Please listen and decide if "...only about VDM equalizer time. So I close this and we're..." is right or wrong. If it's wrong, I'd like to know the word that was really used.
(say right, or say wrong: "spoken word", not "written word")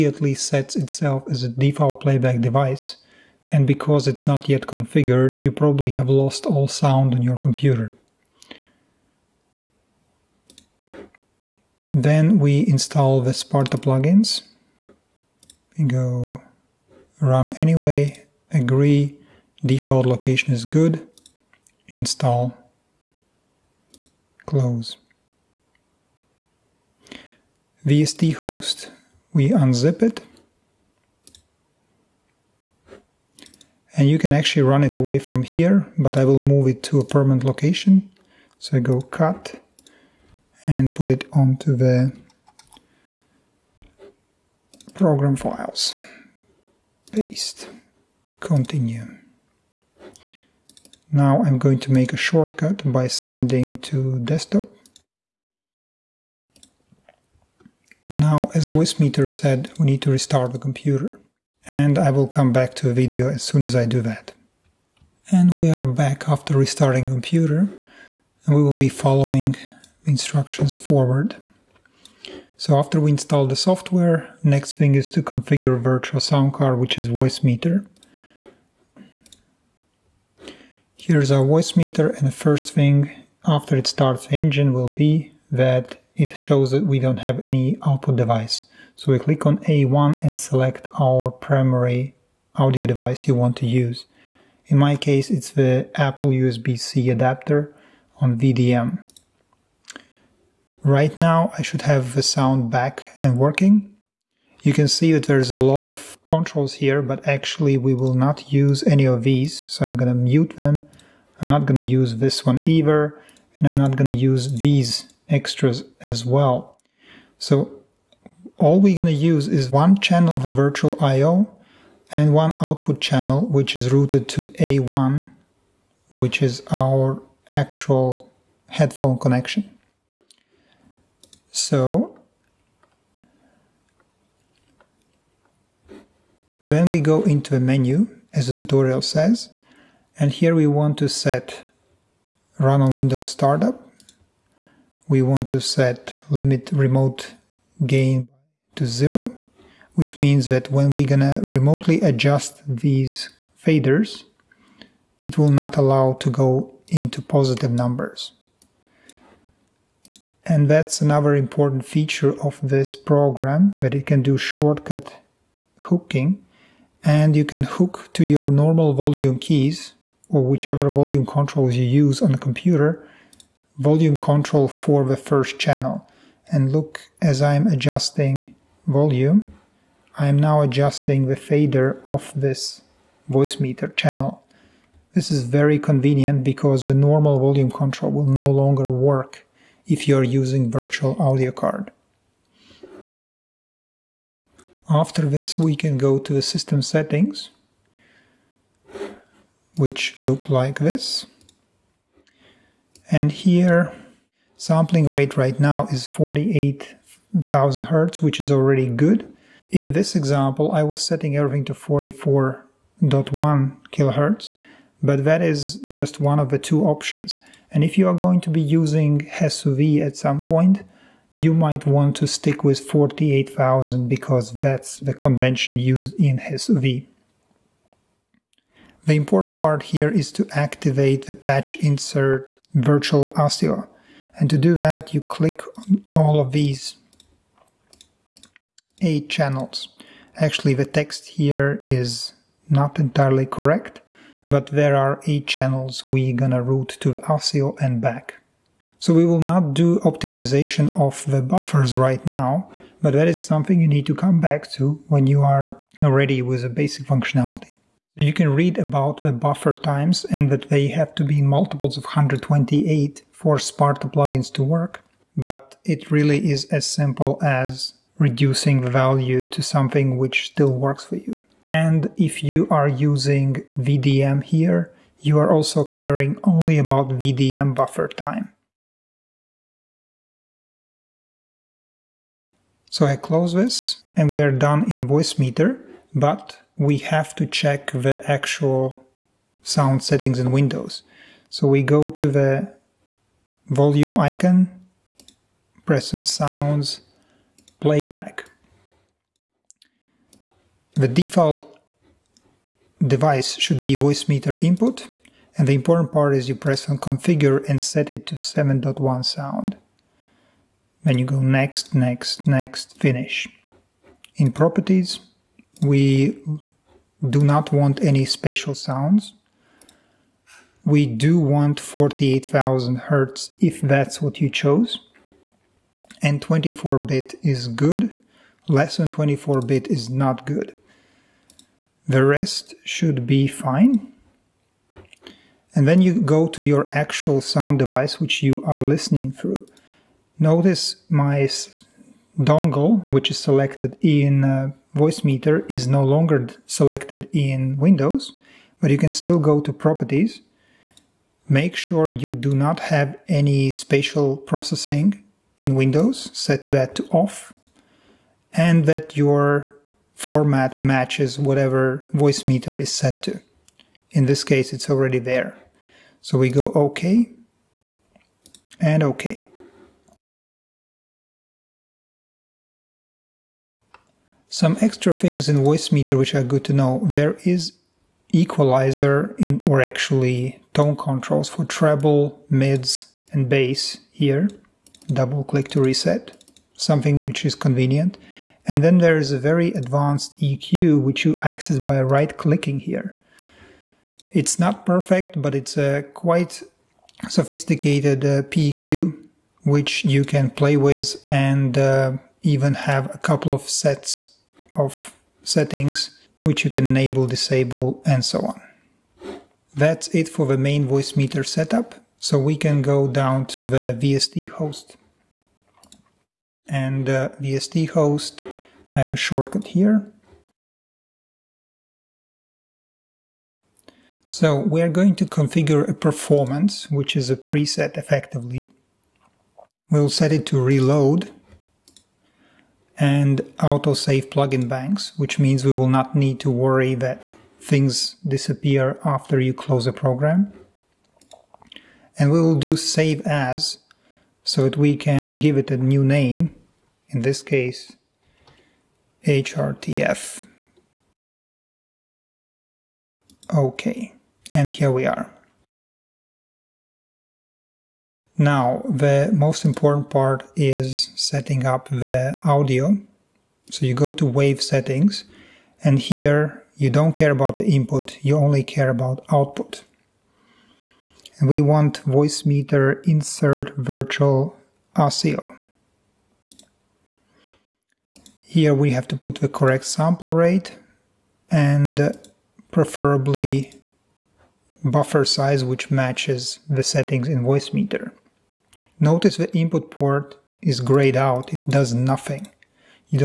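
wrong: "buffer", not "equalizer".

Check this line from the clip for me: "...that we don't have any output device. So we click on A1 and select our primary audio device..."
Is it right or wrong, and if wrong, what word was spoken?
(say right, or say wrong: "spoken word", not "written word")
right.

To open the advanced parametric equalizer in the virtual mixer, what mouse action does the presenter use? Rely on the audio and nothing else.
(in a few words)
right clicking.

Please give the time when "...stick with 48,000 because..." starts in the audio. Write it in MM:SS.
03:42.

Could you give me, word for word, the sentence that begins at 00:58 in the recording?
Now, as VoiceMeeter said, we need to restart the computer.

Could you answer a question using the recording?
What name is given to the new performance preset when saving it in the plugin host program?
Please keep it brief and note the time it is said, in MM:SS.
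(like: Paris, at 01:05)
hrtf, at 07:29.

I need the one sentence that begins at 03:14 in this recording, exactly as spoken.
After this, we can go to the system settings, which look like this.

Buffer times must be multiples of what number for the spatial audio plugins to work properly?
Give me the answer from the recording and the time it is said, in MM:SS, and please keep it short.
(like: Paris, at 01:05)
128, at 04:22.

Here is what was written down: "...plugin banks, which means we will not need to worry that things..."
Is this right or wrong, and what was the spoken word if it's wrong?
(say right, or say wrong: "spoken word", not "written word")
right.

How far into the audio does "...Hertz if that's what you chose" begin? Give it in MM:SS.
05:23.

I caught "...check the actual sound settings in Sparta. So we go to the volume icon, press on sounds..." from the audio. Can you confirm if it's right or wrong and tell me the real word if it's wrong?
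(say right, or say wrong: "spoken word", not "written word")
wrong: "Windows", not "Sparta".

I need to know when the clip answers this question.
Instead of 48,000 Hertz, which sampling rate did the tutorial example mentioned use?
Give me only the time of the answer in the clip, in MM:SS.
03:31.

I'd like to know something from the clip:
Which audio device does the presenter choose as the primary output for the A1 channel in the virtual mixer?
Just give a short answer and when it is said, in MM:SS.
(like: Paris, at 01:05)
Apple USB-C adapter, at 01:35.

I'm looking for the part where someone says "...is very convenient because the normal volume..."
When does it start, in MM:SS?
03:05.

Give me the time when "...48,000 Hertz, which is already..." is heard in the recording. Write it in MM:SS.
03:26.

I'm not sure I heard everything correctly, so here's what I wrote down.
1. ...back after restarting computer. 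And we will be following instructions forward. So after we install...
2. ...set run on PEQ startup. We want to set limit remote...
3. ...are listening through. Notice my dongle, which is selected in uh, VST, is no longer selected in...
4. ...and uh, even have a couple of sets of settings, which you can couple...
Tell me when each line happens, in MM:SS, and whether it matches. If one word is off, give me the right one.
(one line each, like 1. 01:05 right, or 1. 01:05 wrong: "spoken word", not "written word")
1. 01:05 right
2. 02:21 wrong: "Windows", not "PEQ"
3. 05:38 wrong: "VoiceMeeter", not "VST"
4. 06:41 wrong: "enable", not "couple".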